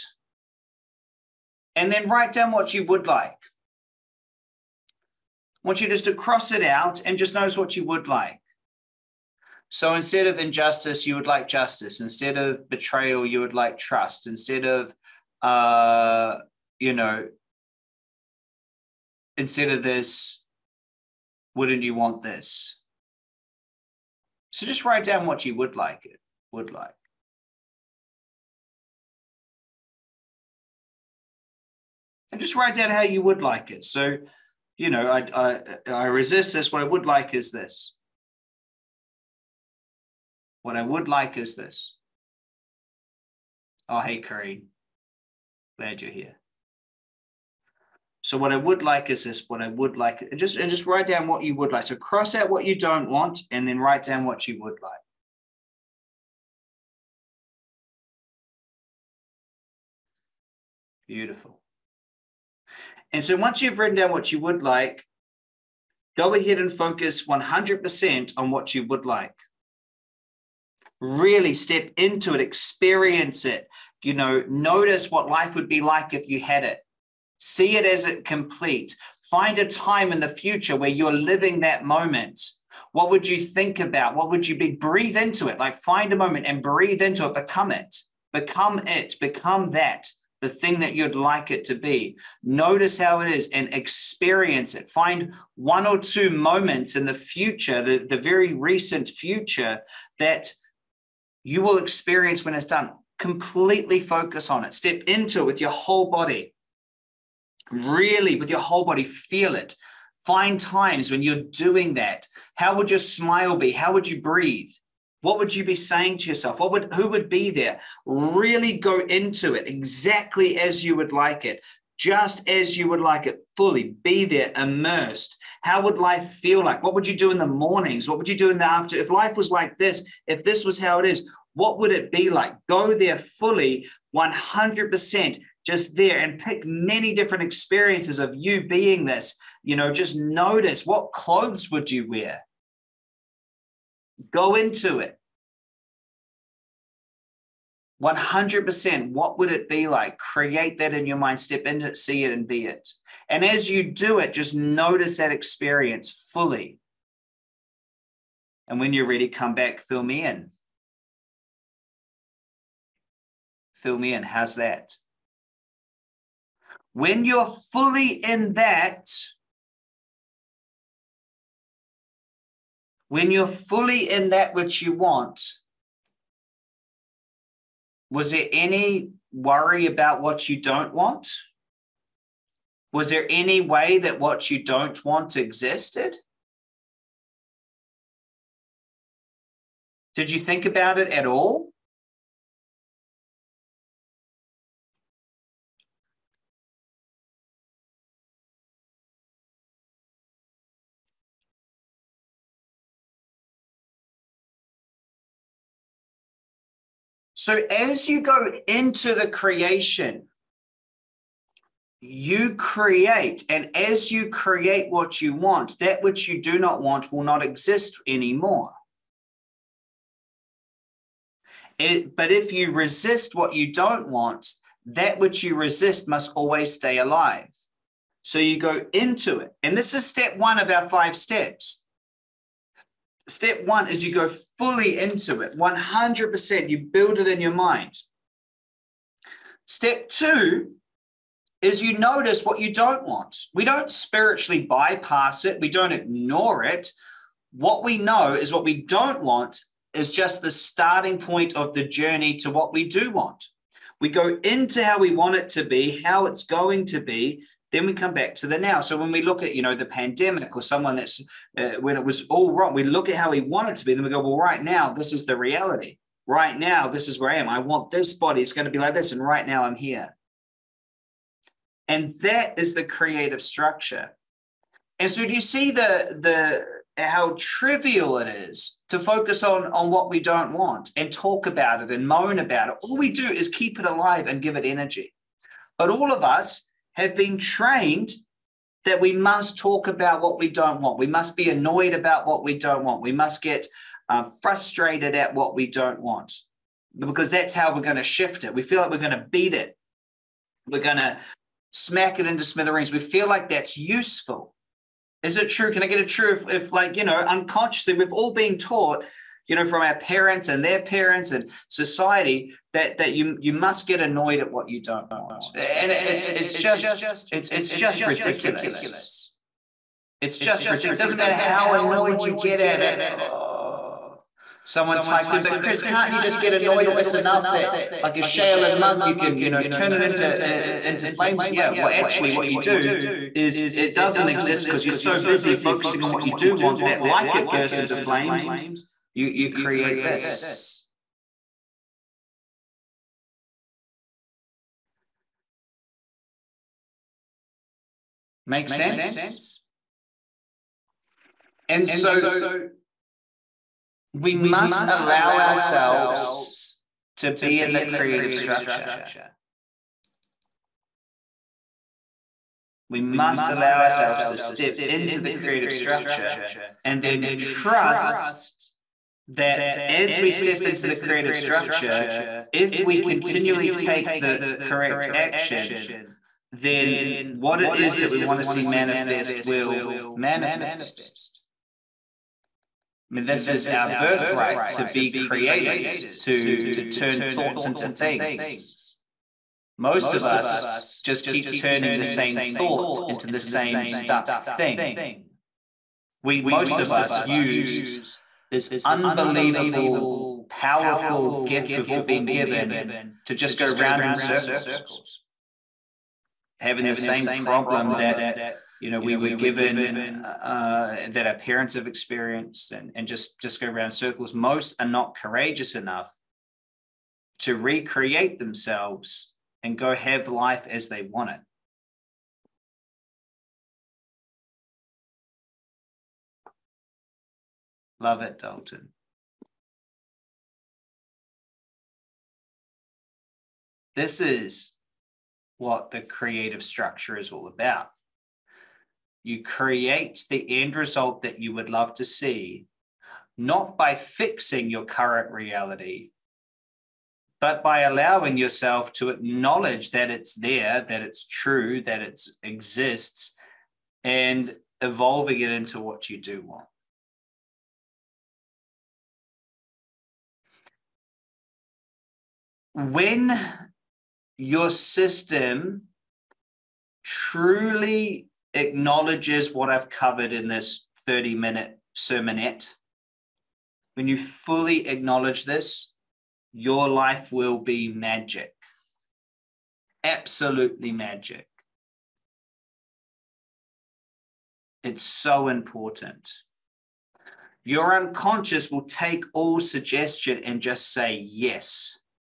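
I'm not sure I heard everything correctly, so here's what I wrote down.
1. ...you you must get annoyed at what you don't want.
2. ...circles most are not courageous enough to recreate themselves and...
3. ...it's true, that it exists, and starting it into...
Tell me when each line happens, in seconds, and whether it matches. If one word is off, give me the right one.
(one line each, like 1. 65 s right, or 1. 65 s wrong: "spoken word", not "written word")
1. 313 s right
2. 413 s right
3. 451 s wrong: "evolving", not "starting".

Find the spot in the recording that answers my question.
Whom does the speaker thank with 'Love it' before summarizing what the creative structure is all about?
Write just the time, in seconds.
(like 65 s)
428 s.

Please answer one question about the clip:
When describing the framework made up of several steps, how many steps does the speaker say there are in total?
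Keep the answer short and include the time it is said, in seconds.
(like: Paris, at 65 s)
5, at 230 s.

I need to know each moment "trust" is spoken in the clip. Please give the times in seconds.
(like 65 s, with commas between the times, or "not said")
13 s, 367 s.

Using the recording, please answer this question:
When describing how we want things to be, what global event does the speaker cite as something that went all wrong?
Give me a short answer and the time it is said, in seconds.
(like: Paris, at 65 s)
The pandemic, at 259 s.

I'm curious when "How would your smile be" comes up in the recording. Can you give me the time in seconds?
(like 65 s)
112 s.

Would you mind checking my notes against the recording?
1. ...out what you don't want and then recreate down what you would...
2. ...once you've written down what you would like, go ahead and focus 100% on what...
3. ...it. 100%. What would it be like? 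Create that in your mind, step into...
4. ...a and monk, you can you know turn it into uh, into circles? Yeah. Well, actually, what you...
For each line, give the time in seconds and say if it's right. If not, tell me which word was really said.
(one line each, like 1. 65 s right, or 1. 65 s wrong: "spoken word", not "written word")
1. 52 s wrong: "write", not "recreate"
2. 63 s right
3. 144 s right
4. 328 s wrong: "flames", not "circles".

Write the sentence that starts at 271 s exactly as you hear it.
And that is the creative structure.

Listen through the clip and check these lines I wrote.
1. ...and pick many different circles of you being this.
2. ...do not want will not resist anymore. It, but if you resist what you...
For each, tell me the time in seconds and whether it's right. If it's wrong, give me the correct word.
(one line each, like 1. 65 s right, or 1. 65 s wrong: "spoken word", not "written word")
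1. 136 s wrong: "experiences", not "circles"
2. 216 s wrong: "exist", not "resist".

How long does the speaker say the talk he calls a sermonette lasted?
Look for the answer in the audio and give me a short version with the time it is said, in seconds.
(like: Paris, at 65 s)
30 minutes, at 471 s.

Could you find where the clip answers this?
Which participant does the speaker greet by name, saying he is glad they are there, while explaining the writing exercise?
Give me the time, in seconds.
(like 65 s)
44 s.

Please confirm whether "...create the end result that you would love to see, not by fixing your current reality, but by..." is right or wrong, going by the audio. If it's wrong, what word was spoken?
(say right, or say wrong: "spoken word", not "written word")
right.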